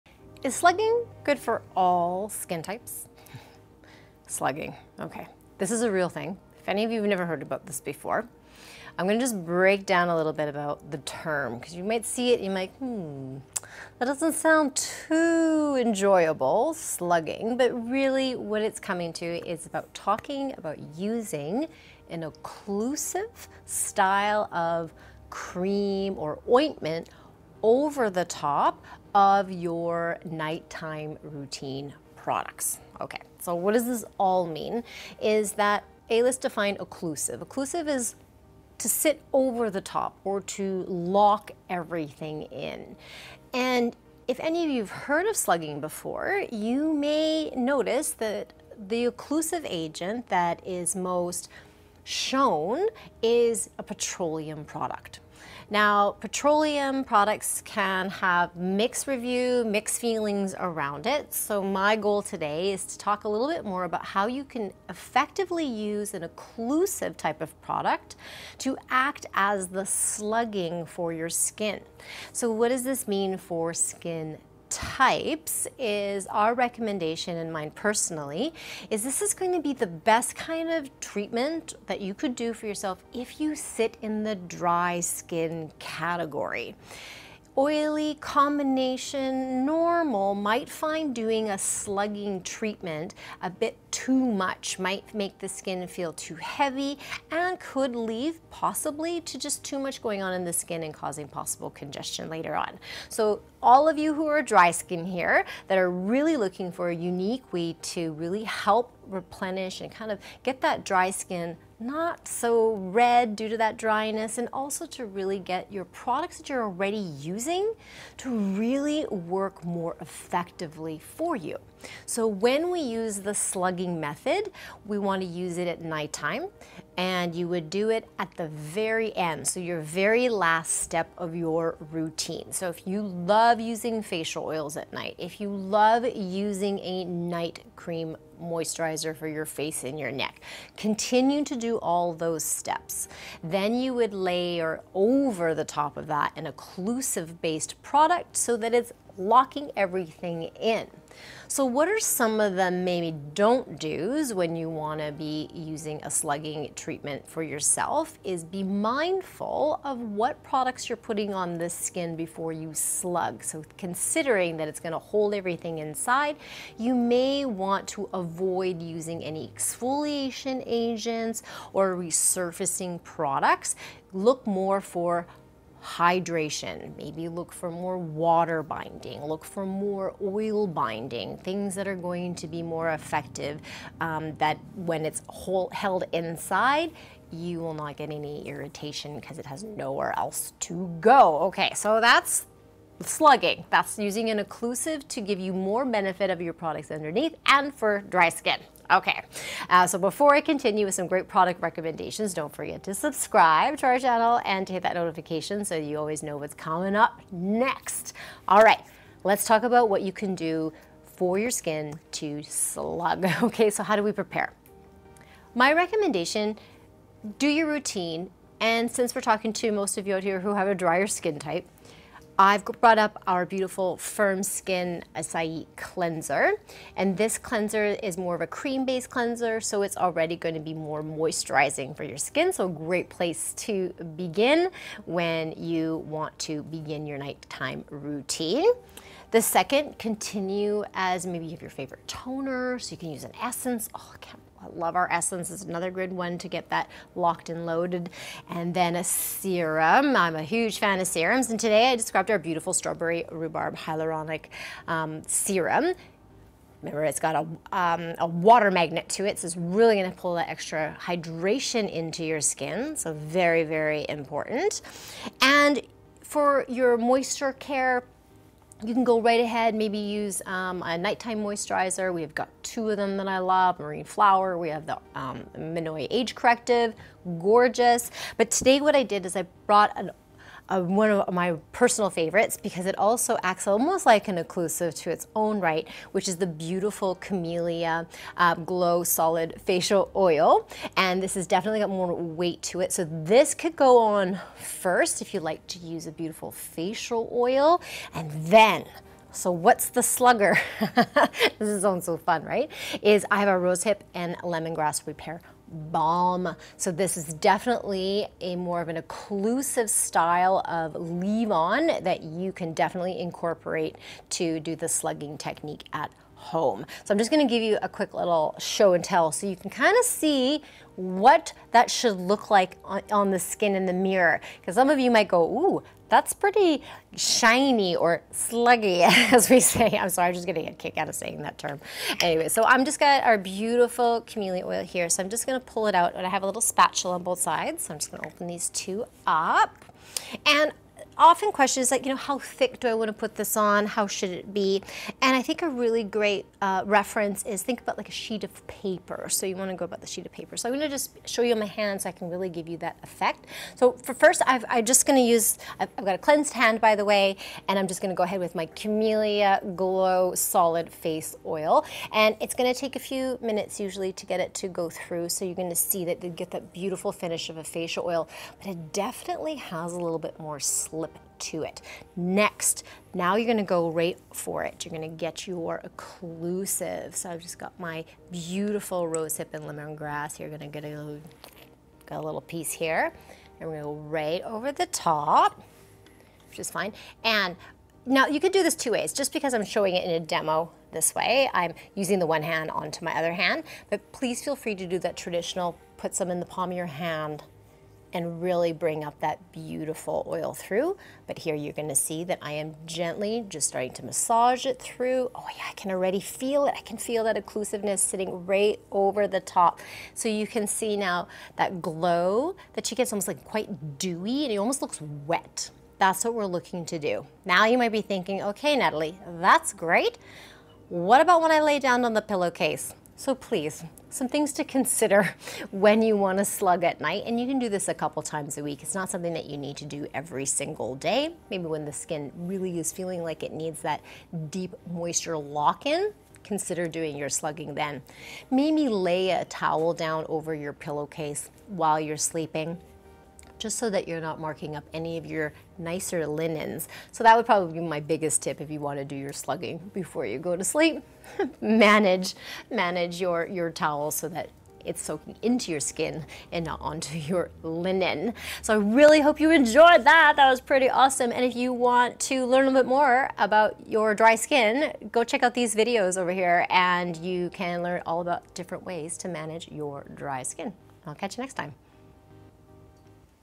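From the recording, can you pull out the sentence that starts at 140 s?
Continue to do all those steps.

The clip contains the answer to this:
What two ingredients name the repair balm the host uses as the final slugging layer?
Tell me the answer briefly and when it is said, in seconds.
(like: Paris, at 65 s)
Rosehip and lemongrass, at 303 s.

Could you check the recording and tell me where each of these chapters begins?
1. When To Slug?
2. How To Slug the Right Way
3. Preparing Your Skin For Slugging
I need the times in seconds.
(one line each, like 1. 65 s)
1. 130 s
2. 157 s
3. 228 s.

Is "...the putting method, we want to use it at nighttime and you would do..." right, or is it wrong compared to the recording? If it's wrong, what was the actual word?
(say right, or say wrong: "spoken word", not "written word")
wrong: "slugging", not "putting".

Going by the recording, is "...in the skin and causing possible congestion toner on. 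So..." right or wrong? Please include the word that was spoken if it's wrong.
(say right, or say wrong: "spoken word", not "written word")
wrong: "later", not "toner".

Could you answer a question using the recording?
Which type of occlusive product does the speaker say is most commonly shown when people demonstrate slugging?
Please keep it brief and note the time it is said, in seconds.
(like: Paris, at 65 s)
Petroleum product, at 53 s.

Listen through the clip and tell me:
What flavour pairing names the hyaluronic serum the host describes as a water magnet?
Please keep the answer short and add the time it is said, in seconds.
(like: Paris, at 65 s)
Strawberry rhubarb, at 252 s.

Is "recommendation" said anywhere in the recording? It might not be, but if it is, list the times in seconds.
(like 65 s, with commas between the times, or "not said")
76 s, 201 s, 215 s.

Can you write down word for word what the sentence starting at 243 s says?
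Oh, I can't love our essence is another good one to get that locked and loaded.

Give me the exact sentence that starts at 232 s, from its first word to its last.
So a great place to begin when you want to begin your nighttime routine.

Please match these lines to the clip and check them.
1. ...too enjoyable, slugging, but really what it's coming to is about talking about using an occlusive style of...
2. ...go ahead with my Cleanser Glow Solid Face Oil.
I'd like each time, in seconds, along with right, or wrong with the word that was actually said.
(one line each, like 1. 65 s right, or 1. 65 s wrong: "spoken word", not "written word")
1. 14 s right
2. 358 s wrong: "Camellia", not "Cleanser".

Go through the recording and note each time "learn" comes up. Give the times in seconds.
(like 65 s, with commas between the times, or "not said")
462 s, 467 s.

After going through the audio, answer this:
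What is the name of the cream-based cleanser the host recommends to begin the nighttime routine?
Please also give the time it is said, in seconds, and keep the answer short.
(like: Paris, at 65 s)
Firm Skin Acai Cleanser, at 223 s.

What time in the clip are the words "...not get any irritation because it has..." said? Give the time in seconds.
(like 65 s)
187 s.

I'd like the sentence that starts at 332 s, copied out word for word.
Anyway, so I'm just got our beautiful camellia oil here.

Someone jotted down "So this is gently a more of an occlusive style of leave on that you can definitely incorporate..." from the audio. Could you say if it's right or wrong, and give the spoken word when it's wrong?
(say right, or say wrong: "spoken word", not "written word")
wrong: "definitely", not "gently".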